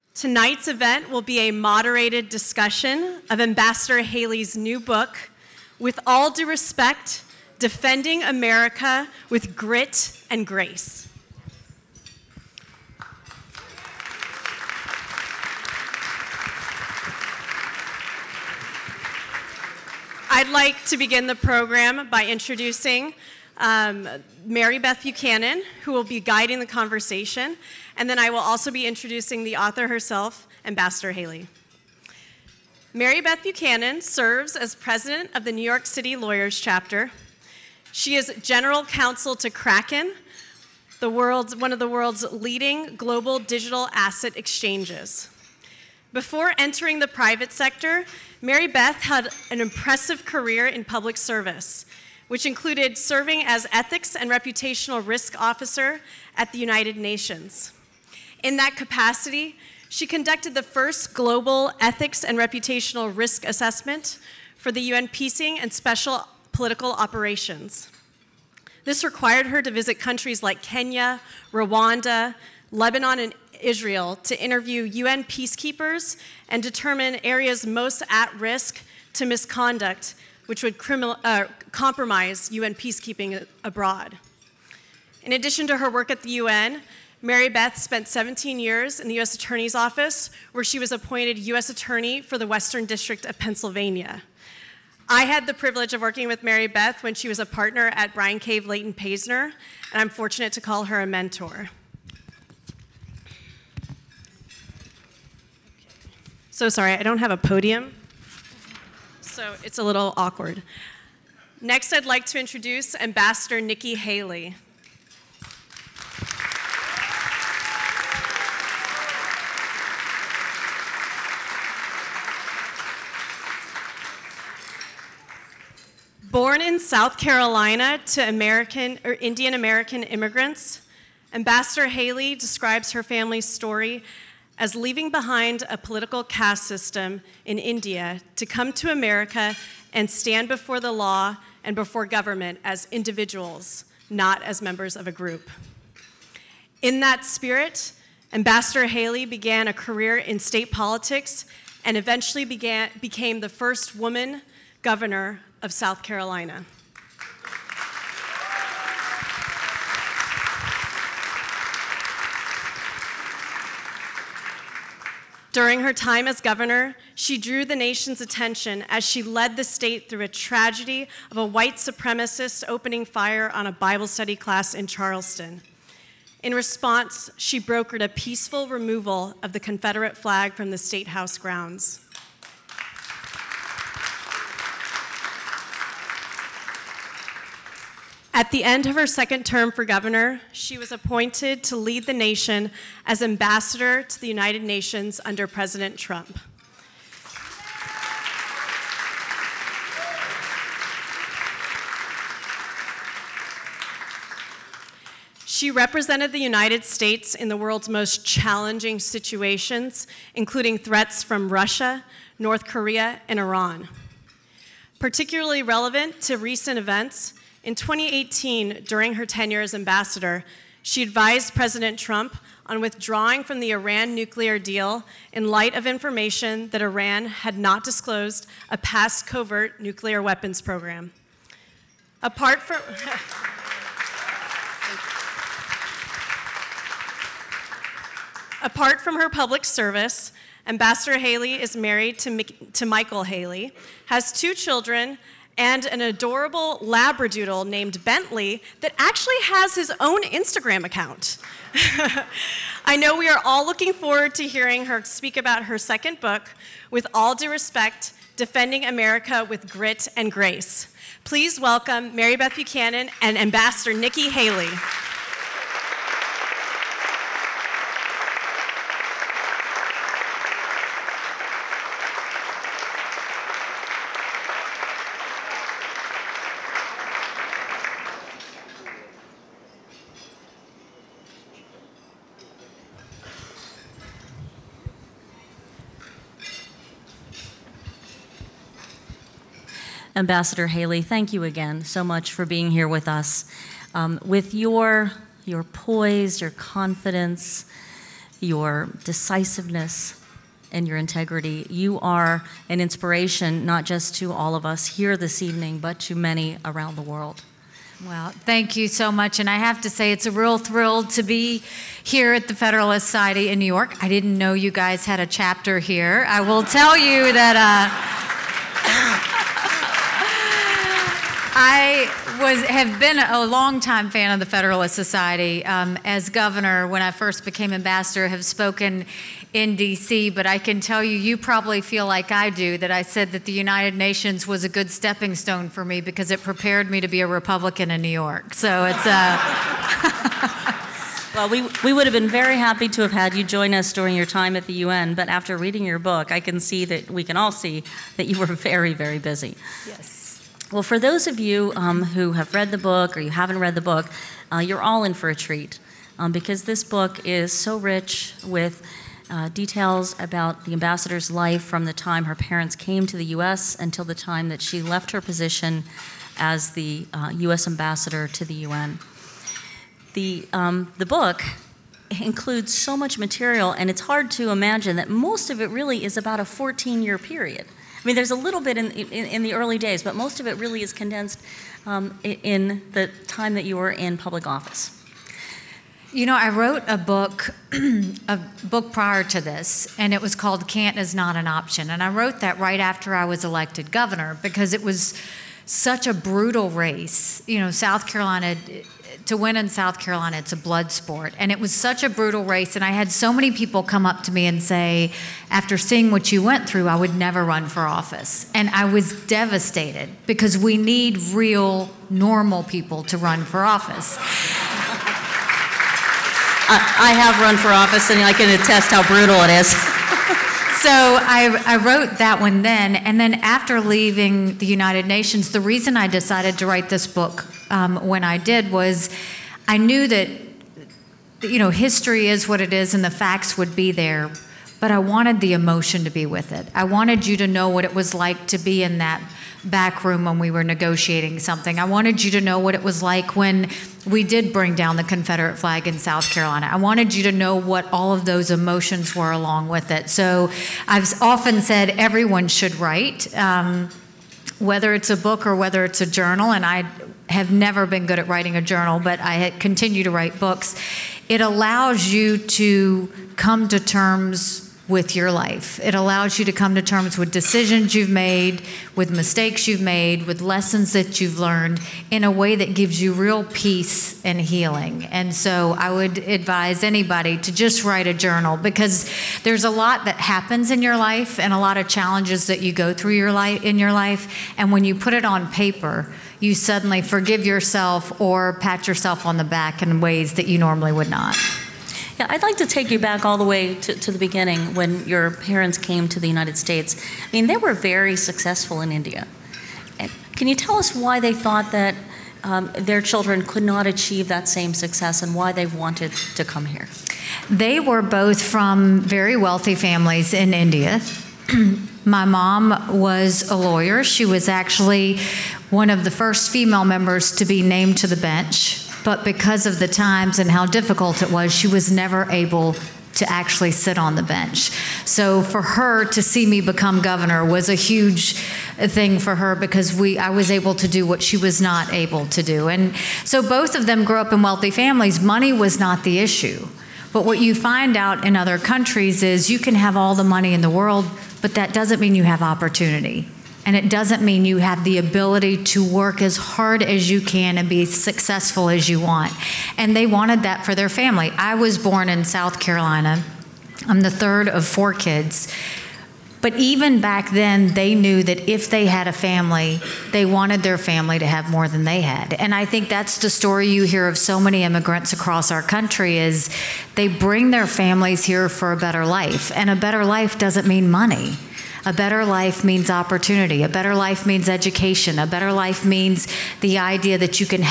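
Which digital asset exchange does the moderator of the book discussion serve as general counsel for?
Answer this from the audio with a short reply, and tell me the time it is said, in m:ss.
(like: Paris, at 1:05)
Kraken, at 0:39.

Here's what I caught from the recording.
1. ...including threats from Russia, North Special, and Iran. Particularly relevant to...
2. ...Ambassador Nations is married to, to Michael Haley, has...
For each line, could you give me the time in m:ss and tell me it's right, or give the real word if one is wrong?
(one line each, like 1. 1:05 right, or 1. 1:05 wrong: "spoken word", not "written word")
1. 3:30 wrong: "Korea", not "Special"
2. 4:00 wrong: "Haley", not "Nations".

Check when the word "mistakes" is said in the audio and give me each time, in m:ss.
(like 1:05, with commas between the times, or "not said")
7:49.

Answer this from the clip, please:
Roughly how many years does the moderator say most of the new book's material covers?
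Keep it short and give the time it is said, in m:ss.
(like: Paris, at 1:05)
14, at 6:16.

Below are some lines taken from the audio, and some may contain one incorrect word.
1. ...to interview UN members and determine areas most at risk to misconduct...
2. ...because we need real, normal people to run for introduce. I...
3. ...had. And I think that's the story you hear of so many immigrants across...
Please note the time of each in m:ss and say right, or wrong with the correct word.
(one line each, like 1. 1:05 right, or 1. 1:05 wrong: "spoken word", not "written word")
1. 1:14 wrong: "peacekeepers", not "members"
2. 6:50 wrong: "office", not "introduce"
3. 9:22 right.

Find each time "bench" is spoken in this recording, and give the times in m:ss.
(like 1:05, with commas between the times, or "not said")
8:38, 8:44.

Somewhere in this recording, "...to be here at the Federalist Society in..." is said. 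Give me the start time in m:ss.
5:11.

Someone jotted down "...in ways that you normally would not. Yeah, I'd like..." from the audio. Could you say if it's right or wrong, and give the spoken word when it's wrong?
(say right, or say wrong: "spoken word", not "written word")
right.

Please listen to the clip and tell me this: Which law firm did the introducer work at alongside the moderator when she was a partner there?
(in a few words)
Bryan Cave Leighton Paisner.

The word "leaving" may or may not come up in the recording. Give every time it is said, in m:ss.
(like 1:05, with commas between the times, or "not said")
2:14, 7:03.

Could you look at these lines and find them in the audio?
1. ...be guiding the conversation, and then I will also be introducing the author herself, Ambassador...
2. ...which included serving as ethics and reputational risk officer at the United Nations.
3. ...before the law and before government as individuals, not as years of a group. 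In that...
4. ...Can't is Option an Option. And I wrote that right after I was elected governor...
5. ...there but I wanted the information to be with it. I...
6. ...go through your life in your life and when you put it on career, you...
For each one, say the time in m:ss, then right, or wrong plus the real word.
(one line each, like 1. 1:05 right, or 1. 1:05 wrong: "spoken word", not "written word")
1. 0:26 right
2. 0:52 right
3. 2:20 wrong: "members", not "years"
4. 6:30 wrong: "Not", not "Option"
5. 7:13 wrong: "emotion", not "information"
6. 8:02 wrong: "paper", not "career".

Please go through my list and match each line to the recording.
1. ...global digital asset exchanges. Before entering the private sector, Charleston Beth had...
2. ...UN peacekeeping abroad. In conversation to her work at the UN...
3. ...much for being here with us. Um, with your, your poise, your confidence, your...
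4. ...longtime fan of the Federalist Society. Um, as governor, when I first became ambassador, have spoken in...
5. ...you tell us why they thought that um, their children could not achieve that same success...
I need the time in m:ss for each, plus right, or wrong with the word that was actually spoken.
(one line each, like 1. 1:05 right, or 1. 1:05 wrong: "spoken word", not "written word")
1. 0:42 wrong: "Mary", not "Charleston"
2. 1:22 wrong: "addition", not "conversation"
3. 4:52 right
4. 5:23 right
5. 8:20 right.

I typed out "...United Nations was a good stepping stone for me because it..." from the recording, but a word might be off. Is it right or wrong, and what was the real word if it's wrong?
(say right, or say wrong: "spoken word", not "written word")
right.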